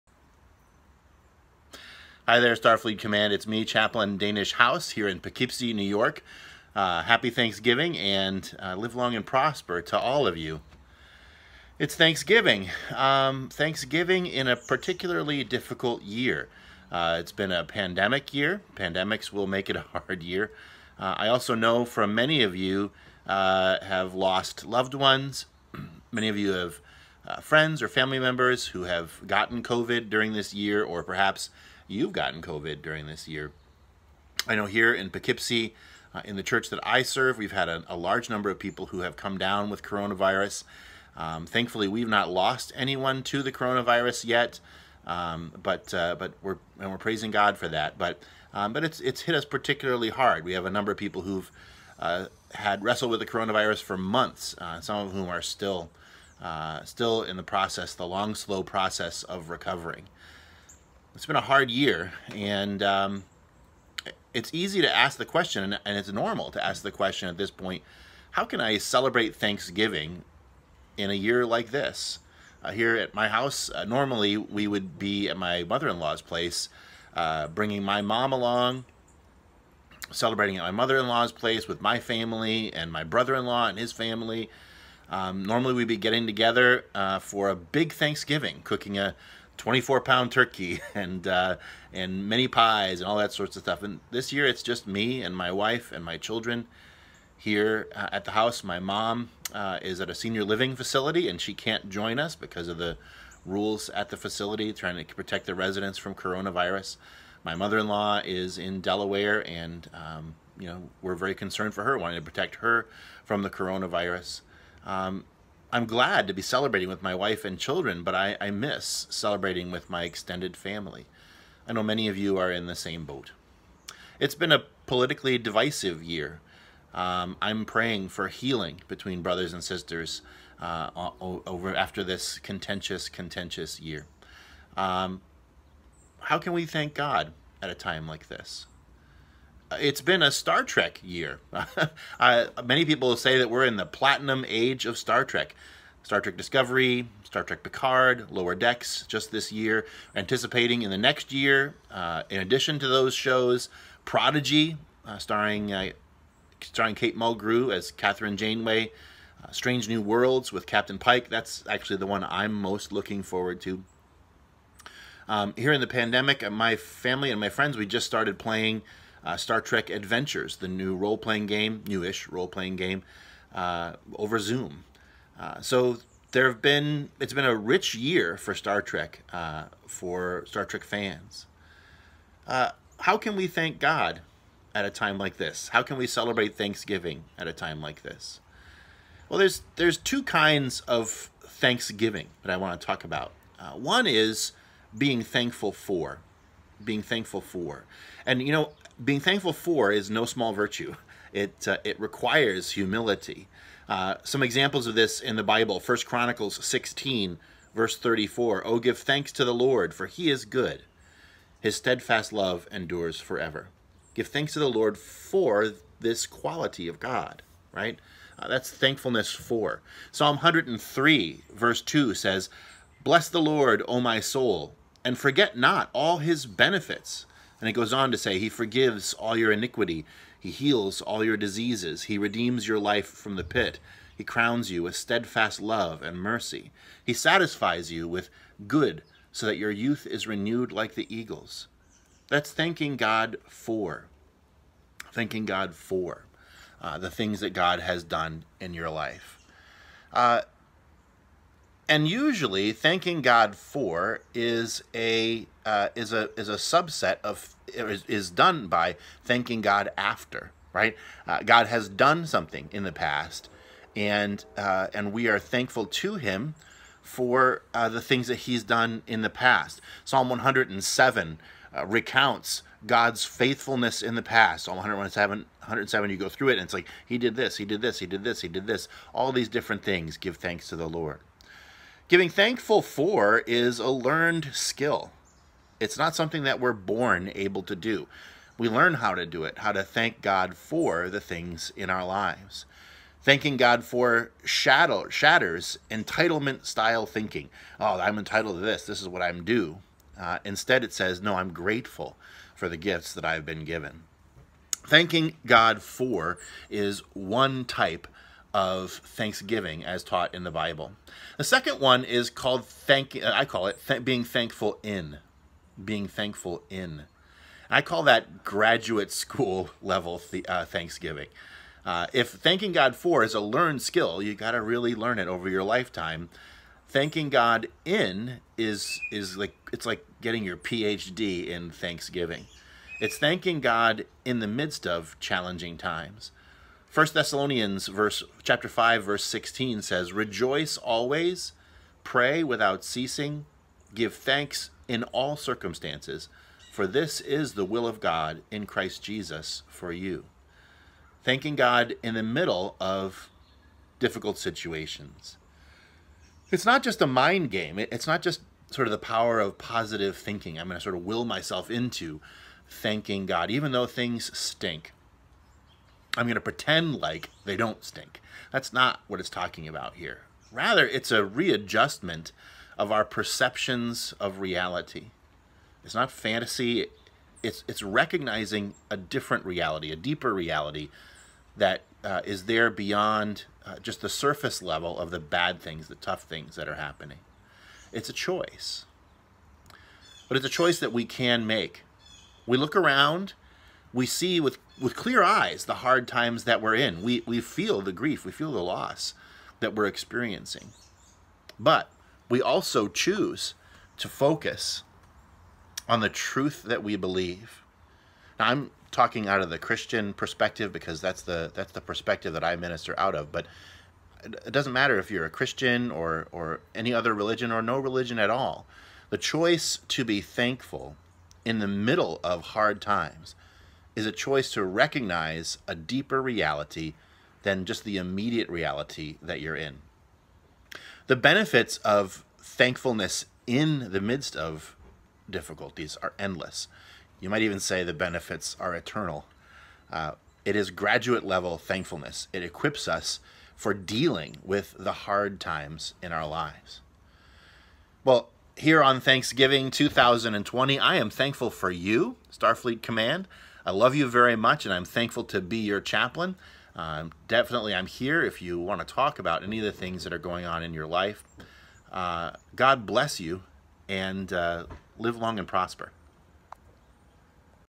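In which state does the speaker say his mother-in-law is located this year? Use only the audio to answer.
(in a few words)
Delaware.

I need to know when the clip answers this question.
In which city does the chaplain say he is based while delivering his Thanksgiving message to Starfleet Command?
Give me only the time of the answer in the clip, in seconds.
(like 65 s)
5 s.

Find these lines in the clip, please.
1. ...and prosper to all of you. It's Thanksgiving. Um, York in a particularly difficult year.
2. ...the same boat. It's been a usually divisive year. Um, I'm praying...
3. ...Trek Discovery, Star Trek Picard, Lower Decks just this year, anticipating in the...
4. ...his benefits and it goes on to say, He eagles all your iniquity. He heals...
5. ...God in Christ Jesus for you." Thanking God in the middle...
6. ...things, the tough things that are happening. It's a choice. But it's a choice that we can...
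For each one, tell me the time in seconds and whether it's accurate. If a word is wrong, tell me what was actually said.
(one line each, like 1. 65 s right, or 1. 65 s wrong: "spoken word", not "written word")
1. 9 s wrong: "Thanksgiving", not "York"
2. 122 s wrong: "politically", not "usually"
3. 146 s right
4. 226 s wrong: "forgives", not "eagles"
5. 348 s right
6. 385 s right.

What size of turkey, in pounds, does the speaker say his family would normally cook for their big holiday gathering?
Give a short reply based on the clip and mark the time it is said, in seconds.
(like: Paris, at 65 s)
24 pound, at 89 s.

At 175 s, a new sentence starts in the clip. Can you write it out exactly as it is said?
Uh, so there have been, it's been a rich year for Star Trek, uh, for Star Trek fans.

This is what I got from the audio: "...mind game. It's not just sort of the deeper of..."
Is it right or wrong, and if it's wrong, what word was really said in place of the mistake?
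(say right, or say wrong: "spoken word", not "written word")
wrong: "power", not "deeper".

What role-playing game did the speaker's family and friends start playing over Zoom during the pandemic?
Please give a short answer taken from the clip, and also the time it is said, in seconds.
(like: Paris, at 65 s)
Star Trek Adventures, at 169 s.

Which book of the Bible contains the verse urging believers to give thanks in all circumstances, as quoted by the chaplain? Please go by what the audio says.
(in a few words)
First Thessalonians.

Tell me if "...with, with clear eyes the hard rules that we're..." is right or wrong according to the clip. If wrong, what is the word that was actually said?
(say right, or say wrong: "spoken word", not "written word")
wrong: "times", not "rules".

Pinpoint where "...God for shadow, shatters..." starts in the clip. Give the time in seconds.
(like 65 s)
293 s.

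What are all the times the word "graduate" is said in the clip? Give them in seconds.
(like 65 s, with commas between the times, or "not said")
318 s, 440 s.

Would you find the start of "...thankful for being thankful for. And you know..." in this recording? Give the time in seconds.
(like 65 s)
195 s.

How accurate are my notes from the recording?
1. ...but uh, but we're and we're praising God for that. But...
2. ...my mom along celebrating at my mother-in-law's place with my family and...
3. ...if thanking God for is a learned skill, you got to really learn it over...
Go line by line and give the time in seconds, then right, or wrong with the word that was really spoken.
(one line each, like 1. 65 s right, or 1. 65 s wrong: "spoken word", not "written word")
1. 45 s right
2. 77 s right
3. 322 s right.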